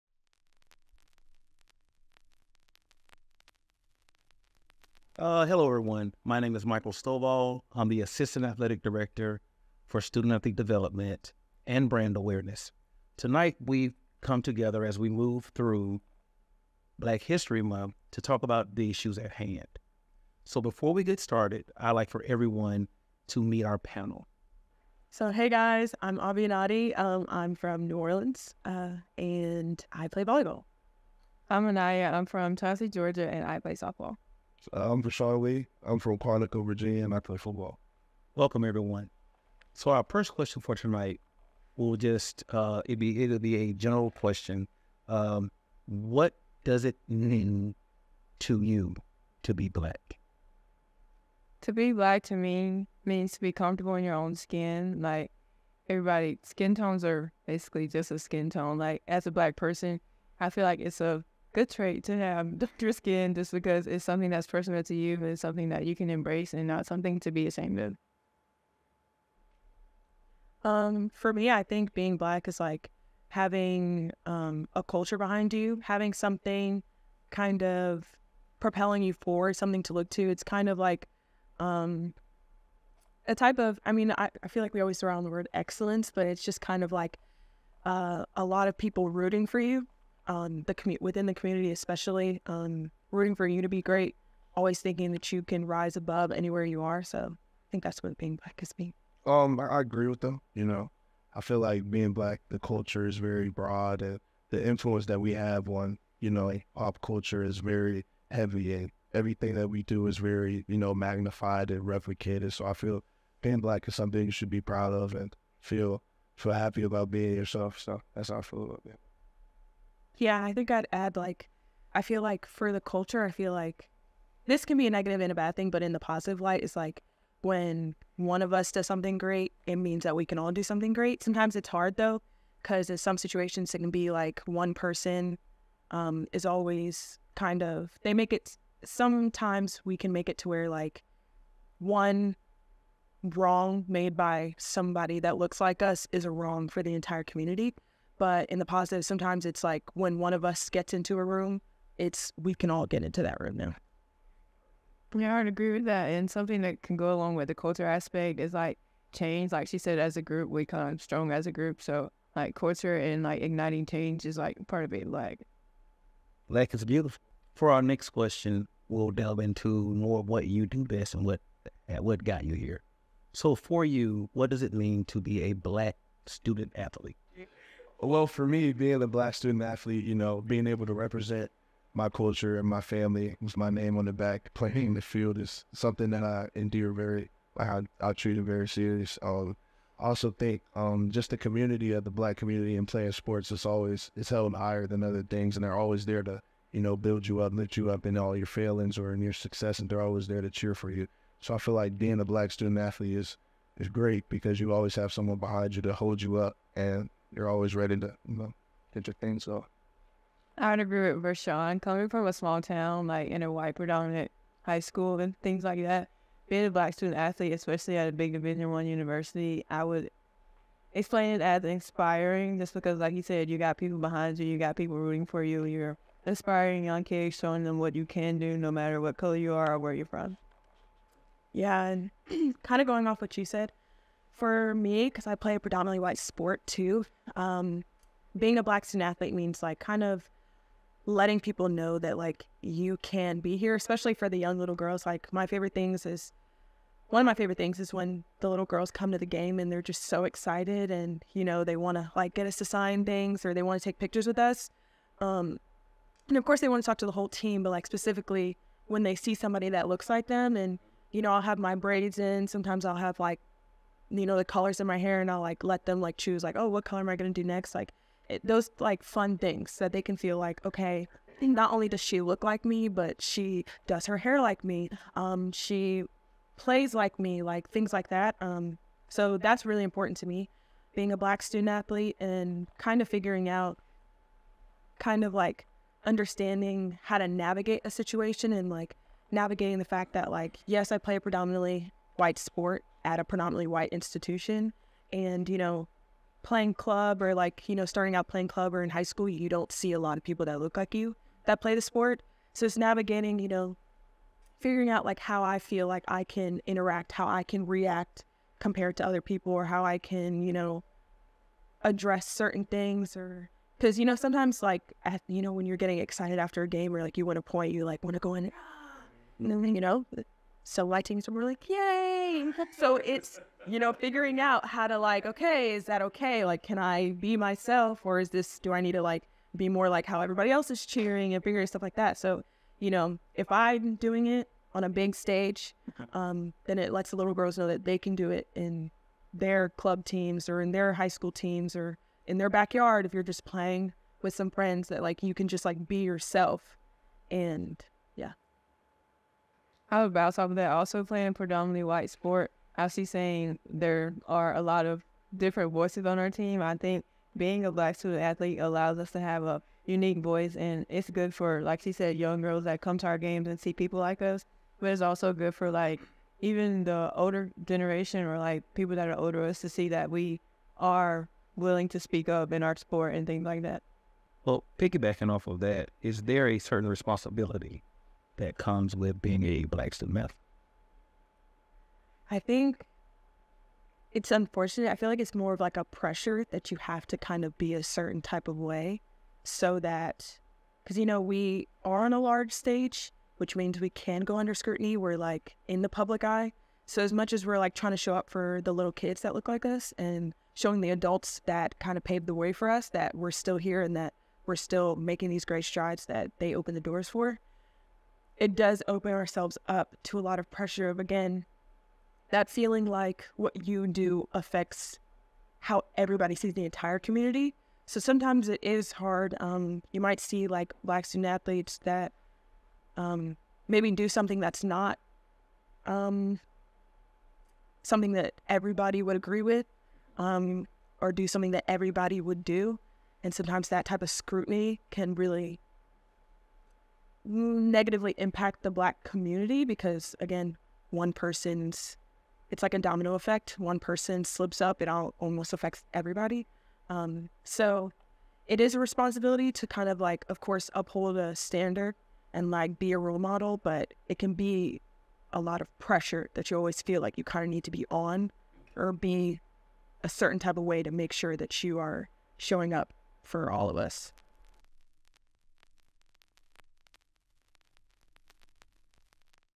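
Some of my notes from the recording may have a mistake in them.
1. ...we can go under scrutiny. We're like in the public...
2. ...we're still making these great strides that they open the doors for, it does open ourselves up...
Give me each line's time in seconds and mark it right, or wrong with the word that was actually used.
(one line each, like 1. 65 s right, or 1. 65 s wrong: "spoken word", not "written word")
1. 393 s right
2. 404 s right.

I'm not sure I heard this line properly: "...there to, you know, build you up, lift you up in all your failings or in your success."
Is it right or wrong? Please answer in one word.
right.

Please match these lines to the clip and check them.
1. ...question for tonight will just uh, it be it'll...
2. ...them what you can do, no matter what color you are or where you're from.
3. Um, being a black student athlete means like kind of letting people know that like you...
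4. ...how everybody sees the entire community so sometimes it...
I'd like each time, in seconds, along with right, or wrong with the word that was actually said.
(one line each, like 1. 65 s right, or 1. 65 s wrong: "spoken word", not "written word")
1. 40 s right
2. 227 s right
3. 237 s right
4. 415 s right.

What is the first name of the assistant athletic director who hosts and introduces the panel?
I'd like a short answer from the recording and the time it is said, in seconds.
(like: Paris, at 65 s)
Michael, at 6 s.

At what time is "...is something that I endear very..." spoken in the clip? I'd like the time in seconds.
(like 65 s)
185 s.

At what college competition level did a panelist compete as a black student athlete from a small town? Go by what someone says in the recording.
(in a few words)
Division One.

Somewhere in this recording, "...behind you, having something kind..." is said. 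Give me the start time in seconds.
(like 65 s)
75 s.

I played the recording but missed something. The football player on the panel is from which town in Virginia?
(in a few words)
Quantico.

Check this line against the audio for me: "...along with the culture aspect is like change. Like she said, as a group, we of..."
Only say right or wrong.
right.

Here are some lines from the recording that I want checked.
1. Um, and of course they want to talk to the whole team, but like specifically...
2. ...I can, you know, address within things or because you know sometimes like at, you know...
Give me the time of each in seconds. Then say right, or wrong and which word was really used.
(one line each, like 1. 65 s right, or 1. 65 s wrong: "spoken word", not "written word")
1. 255 s right
2. 309 s wrong: "certain", not "within".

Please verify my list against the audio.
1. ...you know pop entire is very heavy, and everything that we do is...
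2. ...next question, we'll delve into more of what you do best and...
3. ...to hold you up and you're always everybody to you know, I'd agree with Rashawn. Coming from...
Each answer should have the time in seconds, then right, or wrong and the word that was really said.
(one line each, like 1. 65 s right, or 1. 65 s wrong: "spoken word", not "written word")
1. 106 s wrong: "culture", not "entire"
2. 167 s right
3. 205 s wrong: "ready", not "everybody".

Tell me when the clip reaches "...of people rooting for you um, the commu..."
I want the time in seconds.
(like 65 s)
88 s.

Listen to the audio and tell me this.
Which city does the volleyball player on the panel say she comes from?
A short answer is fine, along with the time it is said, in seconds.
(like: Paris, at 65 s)
New Orleans, at 27 s.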